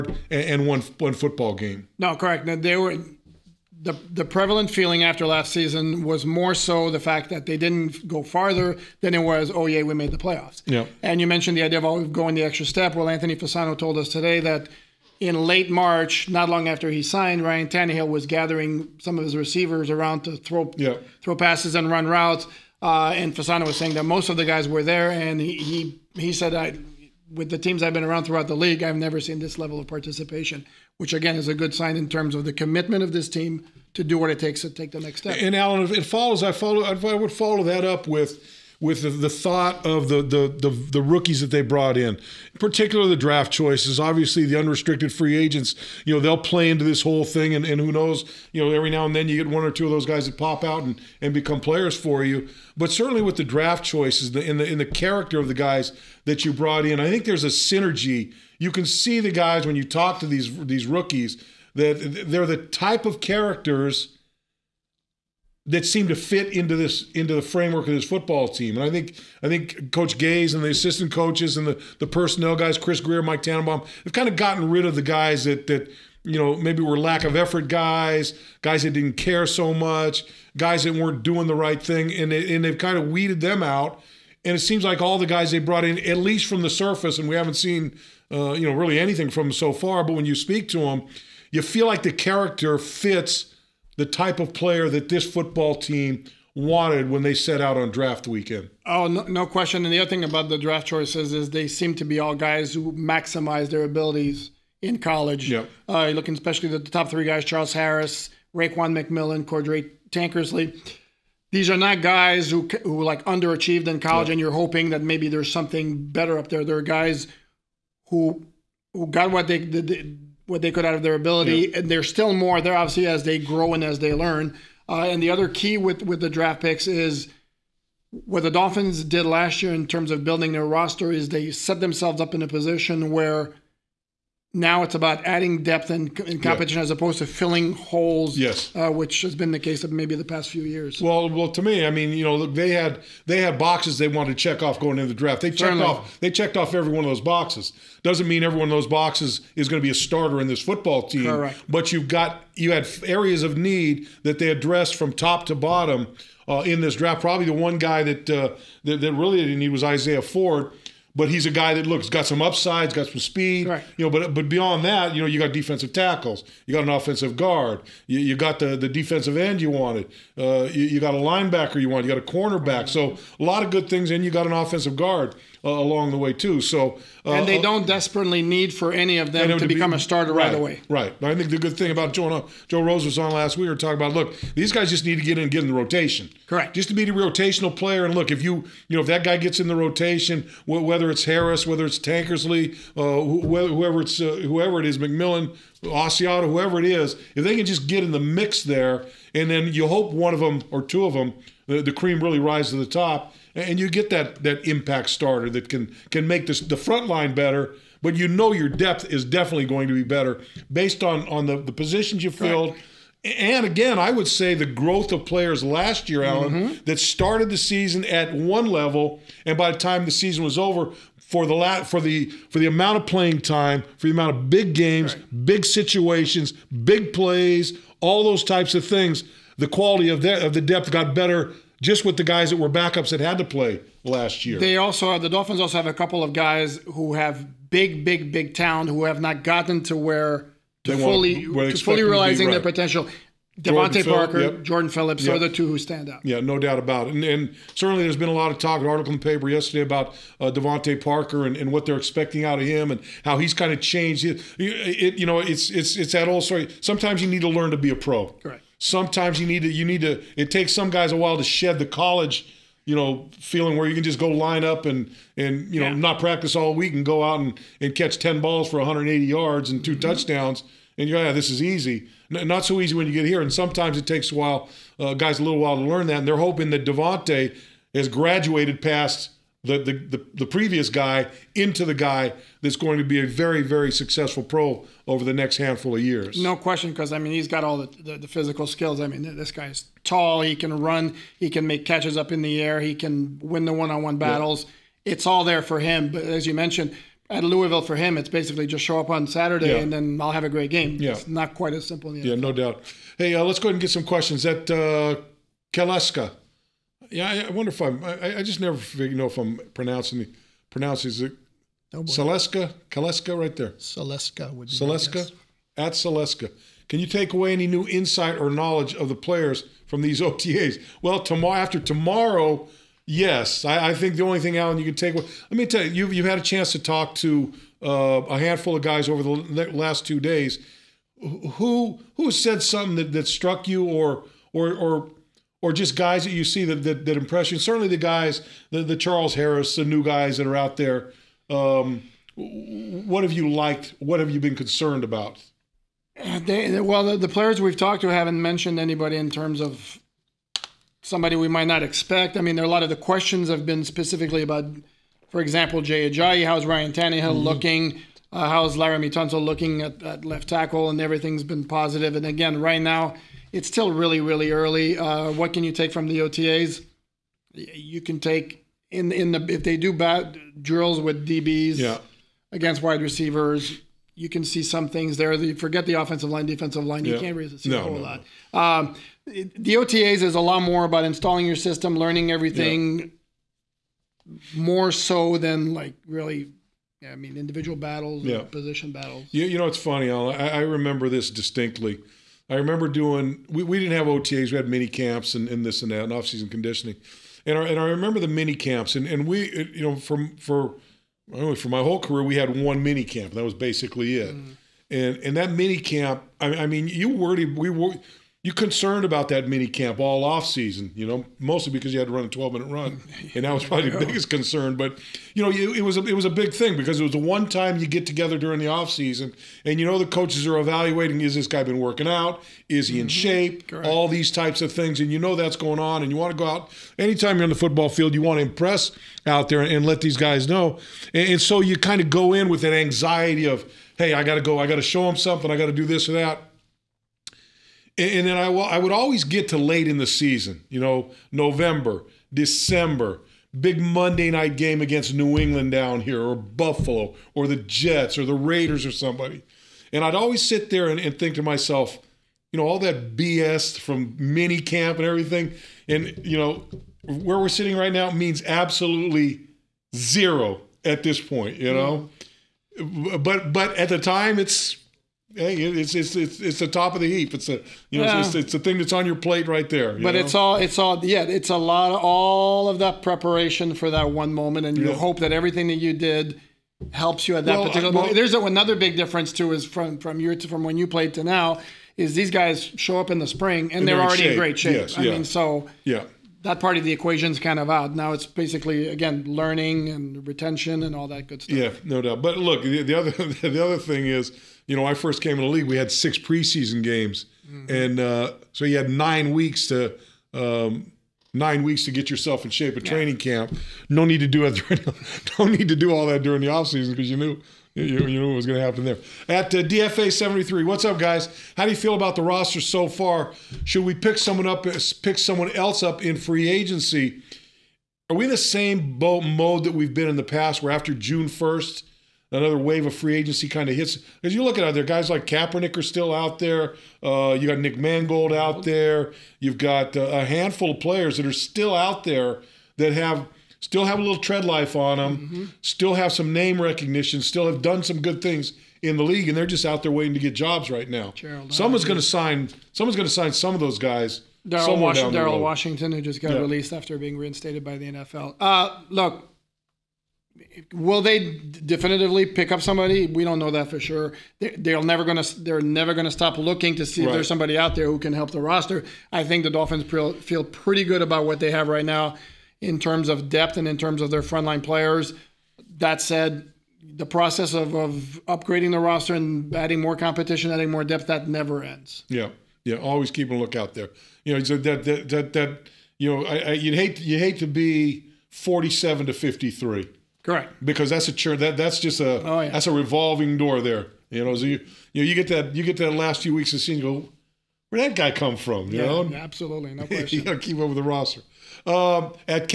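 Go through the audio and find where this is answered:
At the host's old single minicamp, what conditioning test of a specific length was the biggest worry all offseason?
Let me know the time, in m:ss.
6:52.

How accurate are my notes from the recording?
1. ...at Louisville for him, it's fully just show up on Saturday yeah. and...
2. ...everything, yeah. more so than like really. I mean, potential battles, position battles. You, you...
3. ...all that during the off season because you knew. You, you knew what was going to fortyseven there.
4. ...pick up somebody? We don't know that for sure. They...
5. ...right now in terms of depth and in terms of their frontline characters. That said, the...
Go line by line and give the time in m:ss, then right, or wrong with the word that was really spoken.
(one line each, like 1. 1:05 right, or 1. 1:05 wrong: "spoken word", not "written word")
1. 4:57 wrong: "basically", not "fully"
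2. 6:22 wrong: "individual", not "potential"
3. 8:25 wrong: "happen", not "fortyseven"
4. 9:12 right
5. 9:21 wrong: "players", not "characters".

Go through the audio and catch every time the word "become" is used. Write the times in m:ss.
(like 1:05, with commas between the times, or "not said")
0:51, 2:59.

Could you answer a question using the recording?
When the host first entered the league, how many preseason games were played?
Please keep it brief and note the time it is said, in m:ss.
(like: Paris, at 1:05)
6, at 8:15.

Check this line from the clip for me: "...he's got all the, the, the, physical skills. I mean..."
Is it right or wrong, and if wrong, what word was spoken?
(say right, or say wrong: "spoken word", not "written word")
right.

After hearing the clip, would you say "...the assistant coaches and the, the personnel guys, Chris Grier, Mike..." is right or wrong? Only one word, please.
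right.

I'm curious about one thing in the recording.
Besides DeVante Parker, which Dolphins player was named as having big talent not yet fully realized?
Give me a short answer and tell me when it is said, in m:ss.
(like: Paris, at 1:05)
Jordan Phillips, at 4:04.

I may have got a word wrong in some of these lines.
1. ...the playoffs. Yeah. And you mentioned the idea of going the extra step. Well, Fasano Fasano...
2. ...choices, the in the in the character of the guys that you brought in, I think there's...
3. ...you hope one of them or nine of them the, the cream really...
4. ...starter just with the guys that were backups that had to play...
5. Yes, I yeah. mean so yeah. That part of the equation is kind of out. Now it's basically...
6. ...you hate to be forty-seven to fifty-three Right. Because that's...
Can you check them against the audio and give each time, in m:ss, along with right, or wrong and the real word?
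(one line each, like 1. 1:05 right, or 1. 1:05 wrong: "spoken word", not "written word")
1. 0:10 wrong: "Anthony", not "Fasano"
2. 0:53 right
3. 3:19 wrong: "two", not "nine"
4. 3:51 wrong: "better", not "starter"
5. 8:04 right
6. 9:37 right.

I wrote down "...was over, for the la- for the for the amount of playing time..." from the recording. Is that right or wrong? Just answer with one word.
right.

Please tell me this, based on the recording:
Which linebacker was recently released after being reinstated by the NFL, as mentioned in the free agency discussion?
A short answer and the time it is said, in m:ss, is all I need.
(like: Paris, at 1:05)
Daryl Washington, at 9:04.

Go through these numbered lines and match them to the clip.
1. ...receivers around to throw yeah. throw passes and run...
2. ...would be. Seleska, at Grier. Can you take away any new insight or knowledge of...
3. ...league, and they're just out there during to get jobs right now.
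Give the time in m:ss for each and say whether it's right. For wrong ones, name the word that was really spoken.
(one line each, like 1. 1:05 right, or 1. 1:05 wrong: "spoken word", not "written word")
1. 0:19 right
2. 5:14 wrong: "Seleska", not "Grier"
3. 8:59 wrong: "waiting", not "during".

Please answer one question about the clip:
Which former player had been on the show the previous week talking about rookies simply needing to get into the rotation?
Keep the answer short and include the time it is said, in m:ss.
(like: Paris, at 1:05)
Joe Rose, at 3:02.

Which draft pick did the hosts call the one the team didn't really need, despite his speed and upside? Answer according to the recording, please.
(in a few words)
Isaiah Ford.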